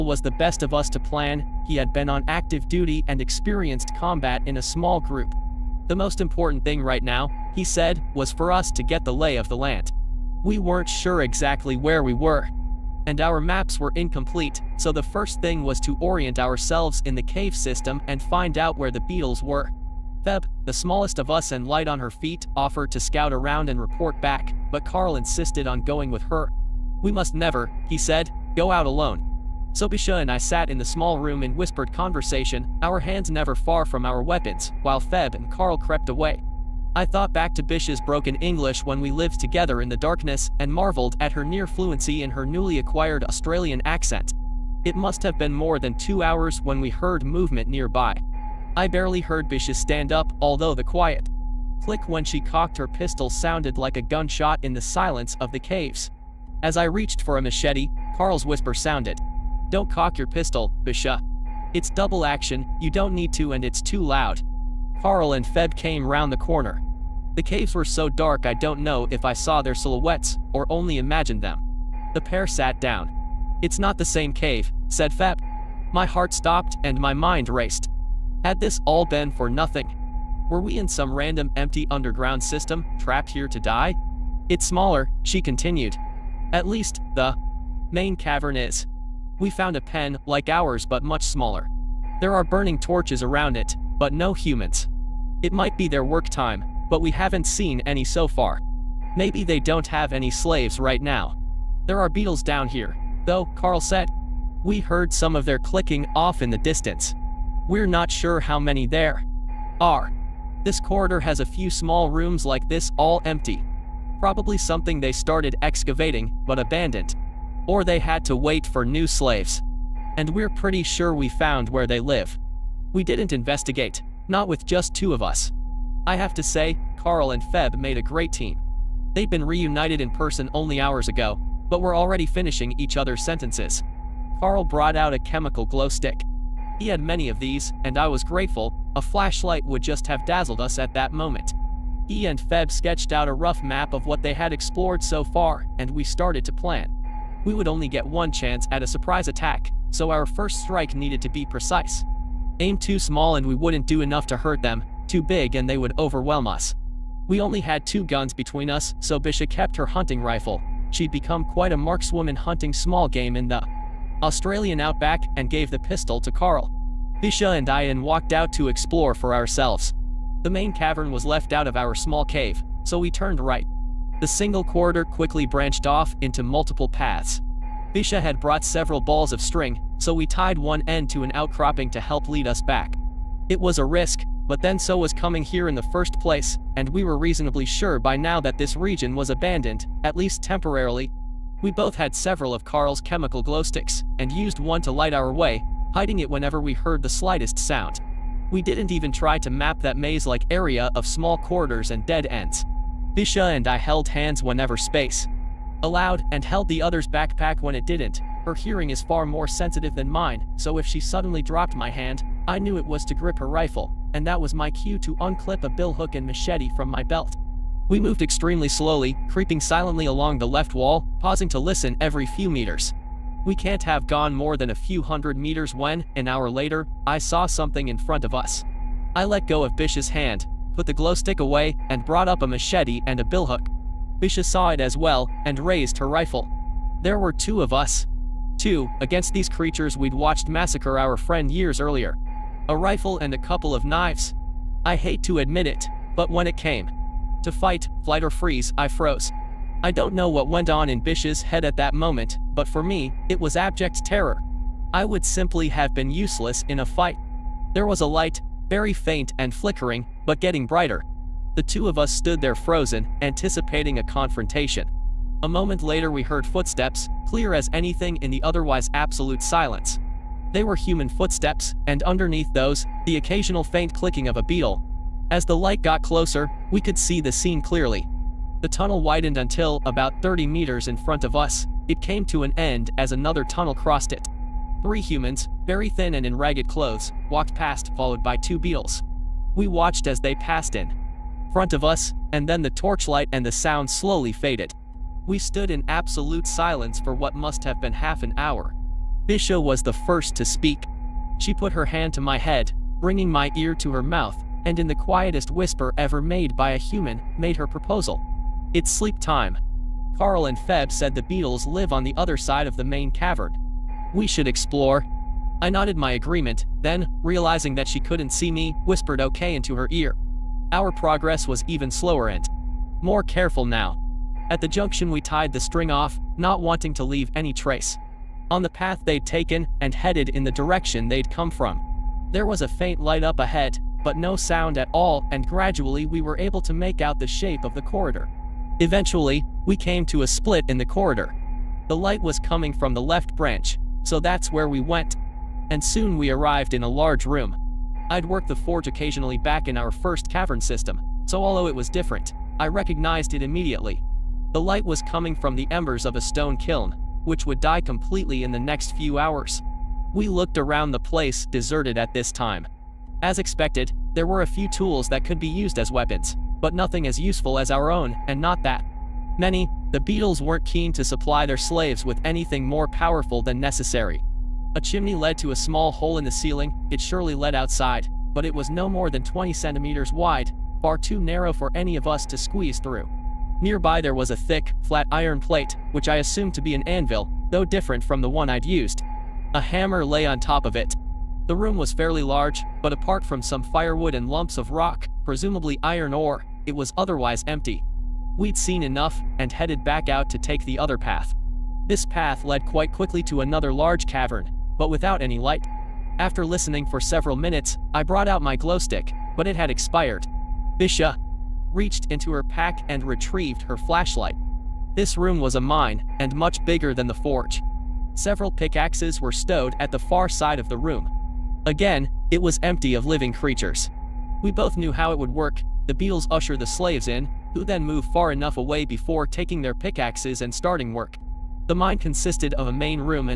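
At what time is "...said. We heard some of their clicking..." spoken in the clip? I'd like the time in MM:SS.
01:43.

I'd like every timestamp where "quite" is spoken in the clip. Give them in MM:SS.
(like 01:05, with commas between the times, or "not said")
02:41, 06:42.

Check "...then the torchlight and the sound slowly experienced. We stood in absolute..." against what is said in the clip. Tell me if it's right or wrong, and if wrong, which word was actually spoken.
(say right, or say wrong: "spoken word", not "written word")
wrong: "faded", not "experienced".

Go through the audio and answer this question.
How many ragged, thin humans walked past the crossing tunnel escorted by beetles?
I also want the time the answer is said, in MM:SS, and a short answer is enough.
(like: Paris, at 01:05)
3, at 04:44.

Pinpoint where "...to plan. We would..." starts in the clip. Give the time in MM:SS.
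02:26.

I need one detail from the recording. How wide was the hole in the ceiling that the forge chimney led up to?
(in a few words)
20 centimeters.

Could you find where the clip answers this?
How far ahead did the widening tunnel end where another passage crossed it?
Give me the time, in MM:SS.
04:40.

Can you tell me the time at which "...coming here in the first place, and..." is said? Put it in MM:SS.
03:05.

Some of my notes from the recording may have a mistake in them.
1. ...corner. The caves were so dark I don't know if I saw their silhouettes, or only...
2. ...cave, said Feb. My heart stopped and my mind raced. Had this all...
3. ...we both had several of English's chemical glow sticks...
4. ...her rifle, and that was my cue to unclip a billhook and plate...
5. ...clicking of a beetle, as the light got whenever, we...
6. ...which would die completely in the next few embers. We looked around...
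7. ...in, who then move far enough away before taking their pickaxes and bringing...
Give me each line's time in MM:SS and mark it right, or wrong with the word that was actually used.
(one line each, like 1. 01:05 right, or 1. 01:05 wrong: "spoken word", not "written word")
1. 01:06 right
2. 01:14 right
3. 03:11 wrong: "Carl", not "English"
4. 03:33 wrong: "machete", not "plate"
5. 04:33 wrong: "closer", not "whenever"
6. 05:57 wrong: "hours", not "embers"
7. 07:07 wrong: "starting", not "bringing".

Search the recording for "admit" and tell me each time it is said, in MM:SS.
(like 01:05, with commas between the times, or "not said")
04:05.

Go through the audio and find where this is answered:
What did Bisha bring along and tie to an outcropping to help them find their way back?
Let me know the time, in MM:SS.
02:58.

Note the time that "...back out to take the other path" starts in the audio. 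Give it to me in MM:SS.
06:39.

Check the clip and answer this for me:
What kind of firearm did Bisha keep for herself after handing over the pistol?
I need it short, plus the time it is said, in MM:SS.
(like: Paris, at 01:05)
Hunting rifle, at 02:39.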